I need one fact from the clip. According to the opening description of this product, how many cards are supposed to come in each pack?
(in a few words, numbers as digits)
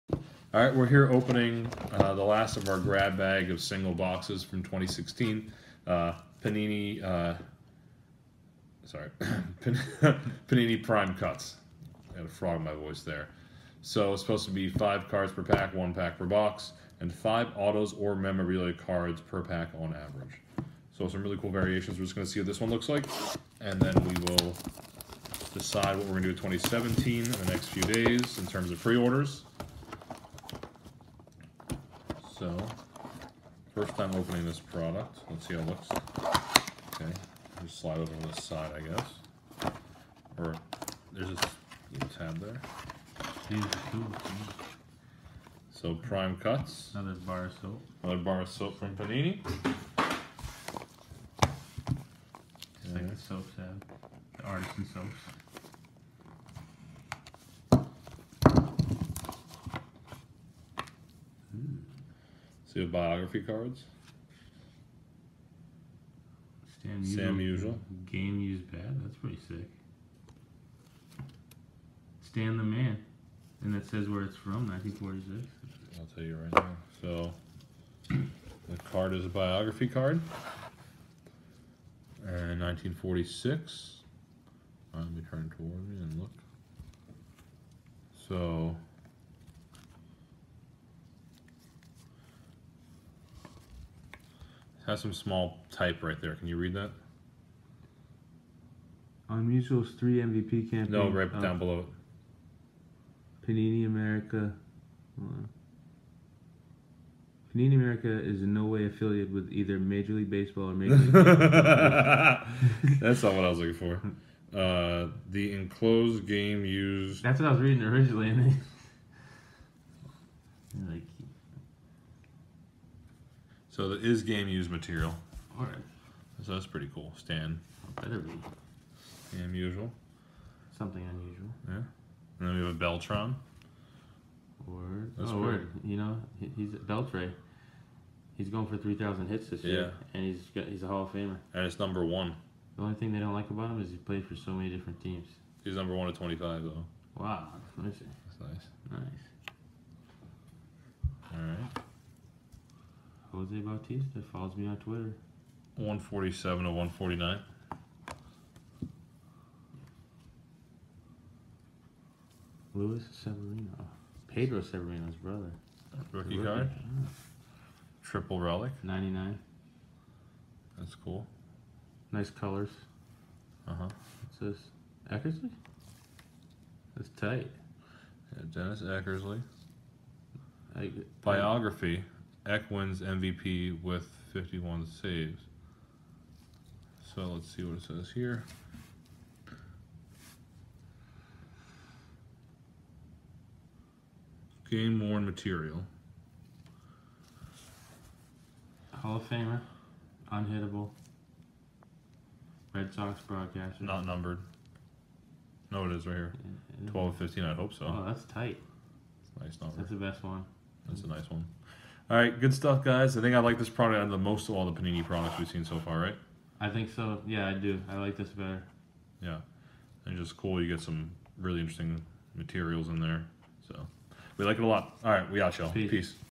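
5.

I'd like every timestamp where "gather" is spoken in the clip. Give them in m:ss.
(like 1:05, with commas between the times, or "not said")
not said.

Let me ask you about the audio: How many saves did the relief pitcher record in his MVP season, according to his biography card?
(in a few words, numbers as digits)
51.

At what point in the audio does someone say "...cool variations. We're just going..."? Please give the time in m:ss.
0:21.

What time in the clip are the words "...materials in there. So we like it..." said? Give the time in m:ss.
3:42.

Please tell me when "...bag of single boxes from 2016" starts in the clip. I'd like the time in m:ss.
0:03.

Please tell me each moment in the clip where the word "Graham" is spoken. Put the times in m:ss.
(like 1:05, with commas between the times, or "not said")
not said.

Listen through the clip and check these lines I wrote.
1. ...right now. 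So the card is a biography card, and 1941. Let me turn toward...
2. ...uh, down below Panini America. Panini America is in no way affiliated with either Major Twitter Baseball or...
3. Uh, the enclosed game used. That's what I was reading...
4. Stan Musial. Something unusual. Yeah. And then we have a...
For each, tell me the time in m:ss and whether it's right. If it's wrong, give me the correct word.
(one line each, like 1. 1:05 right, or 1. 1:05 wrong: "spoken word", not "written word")
1. 1:16 wrong: "1946", not "1941"
2. 1:41 wrong: "League", not "Twitter"
3. 1:54 right
4. 2:09 right.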